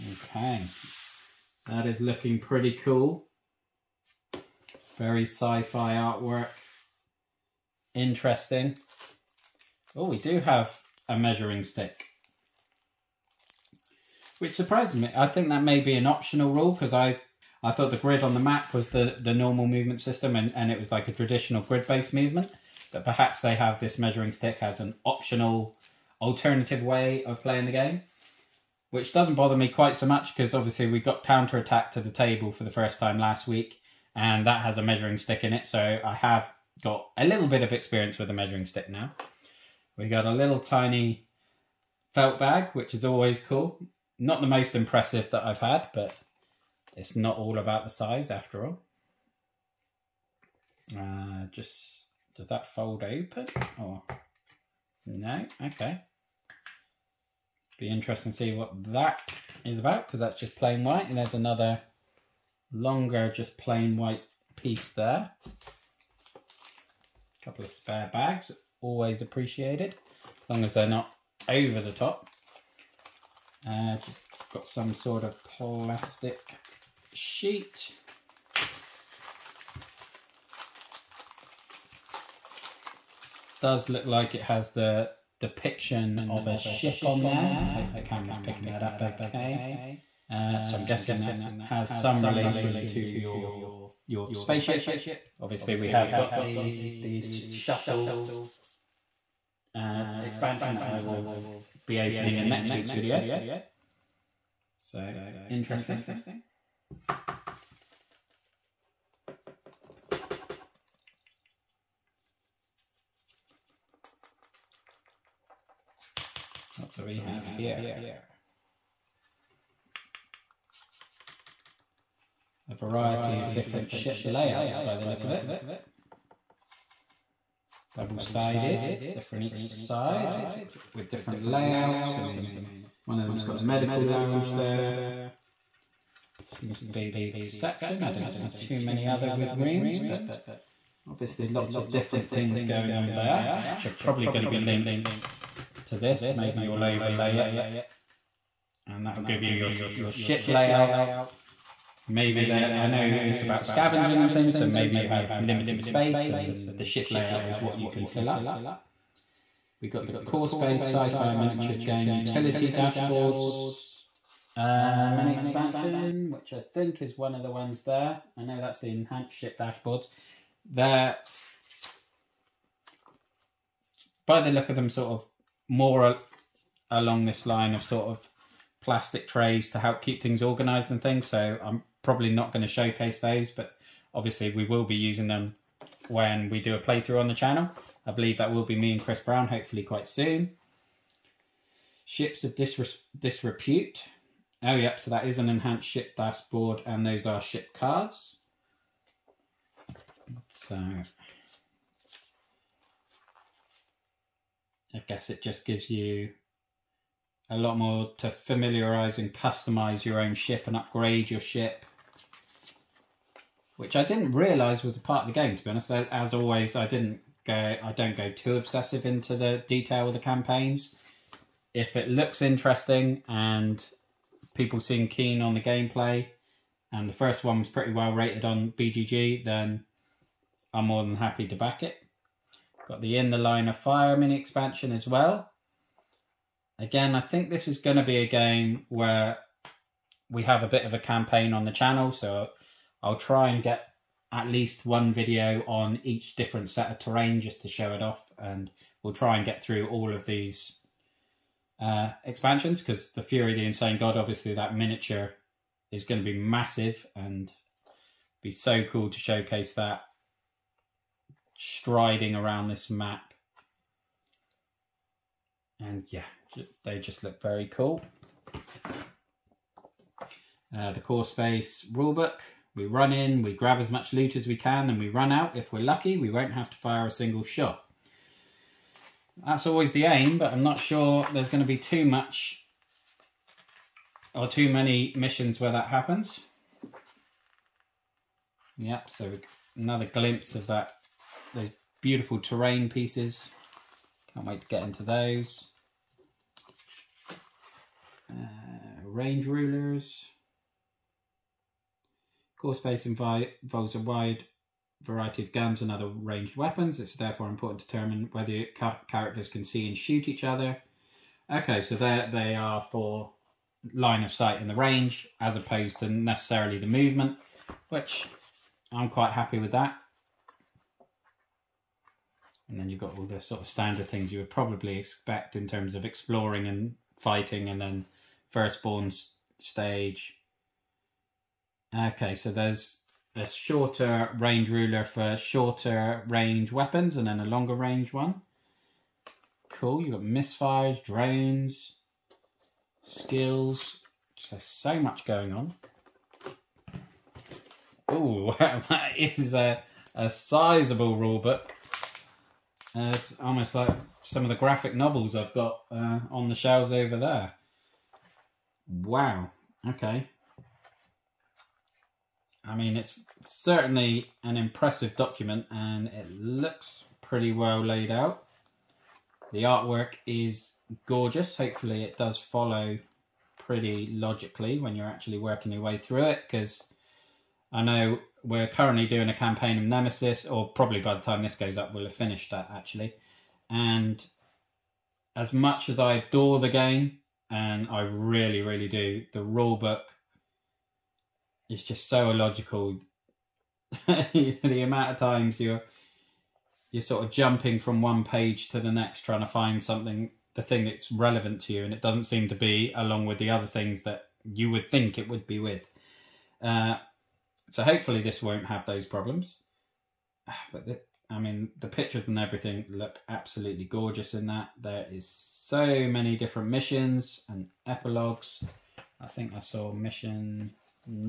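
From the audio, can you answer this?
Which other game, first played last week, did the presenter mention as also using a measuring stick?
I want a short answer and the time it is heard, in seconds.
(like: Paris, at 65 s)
Counter Attack, at 31 s.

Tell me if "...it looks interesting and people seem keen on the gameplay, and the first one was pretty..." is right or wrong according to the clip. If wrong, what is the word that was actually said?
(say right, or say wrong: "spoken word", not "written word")
right.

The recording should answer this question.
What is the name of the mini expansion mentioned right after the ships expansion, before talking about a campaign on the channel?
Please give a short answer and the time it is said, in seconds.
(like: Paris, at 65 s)
In the Line of Fire, at 233 s.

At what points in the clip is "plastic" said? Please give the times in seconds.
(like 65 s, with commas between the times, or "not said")
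75 s, 178 s.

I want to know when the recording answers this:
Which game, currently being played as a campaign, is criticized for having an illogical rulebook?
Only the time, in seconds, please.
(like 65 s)
379 s.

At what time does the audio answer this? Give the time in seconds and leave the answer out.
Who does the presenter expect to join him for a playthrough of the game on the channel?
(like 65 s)
189 s.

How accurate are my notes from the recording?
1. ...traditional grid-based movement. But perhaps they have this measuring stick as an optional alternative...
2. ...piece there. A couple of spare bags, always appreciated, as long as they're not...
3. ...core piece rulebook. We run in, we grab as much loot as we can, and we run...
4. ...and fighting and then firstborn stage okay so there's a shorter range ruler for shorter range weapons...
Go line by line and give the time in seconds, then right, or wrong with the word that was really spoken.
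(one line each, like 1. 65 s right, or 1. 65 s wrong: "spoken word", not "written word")
1. 21 s right
2. 64 s right
3. 271 s wrong: "space", not "piece"
4. 326 s right.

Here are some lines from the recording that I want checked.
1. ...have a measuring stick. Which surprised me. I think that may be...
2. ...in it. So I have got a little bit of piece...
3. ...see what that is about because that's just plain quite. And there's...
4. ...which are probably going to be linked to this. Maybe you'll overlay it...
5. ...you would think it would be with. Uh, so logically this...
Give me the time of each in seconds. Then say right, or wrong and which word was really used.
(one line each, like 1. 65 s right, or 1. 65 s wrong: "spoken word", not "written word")
1. 10 s right
2. 35 s wrong: "experience", not "piece"
3. 58 s wrong: "white", not "quite"
4. 143 s right
5. 404 s wrong: "hopefully", not "logically".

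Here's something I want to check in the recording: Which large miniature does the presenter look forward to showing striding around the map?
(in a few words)
Fury the Insane God.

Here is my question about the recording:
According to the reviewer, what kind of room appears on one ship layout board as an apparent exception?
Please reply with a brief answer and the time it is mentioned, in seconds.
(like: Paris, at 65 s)
Medical lounge, at 133 s.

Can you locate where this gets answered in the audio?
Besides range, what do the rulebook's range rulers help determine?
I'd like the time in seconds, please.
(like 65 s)
313 s.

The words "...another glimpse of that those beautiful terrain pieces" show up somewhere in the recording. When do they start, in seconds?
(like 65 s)
289 s.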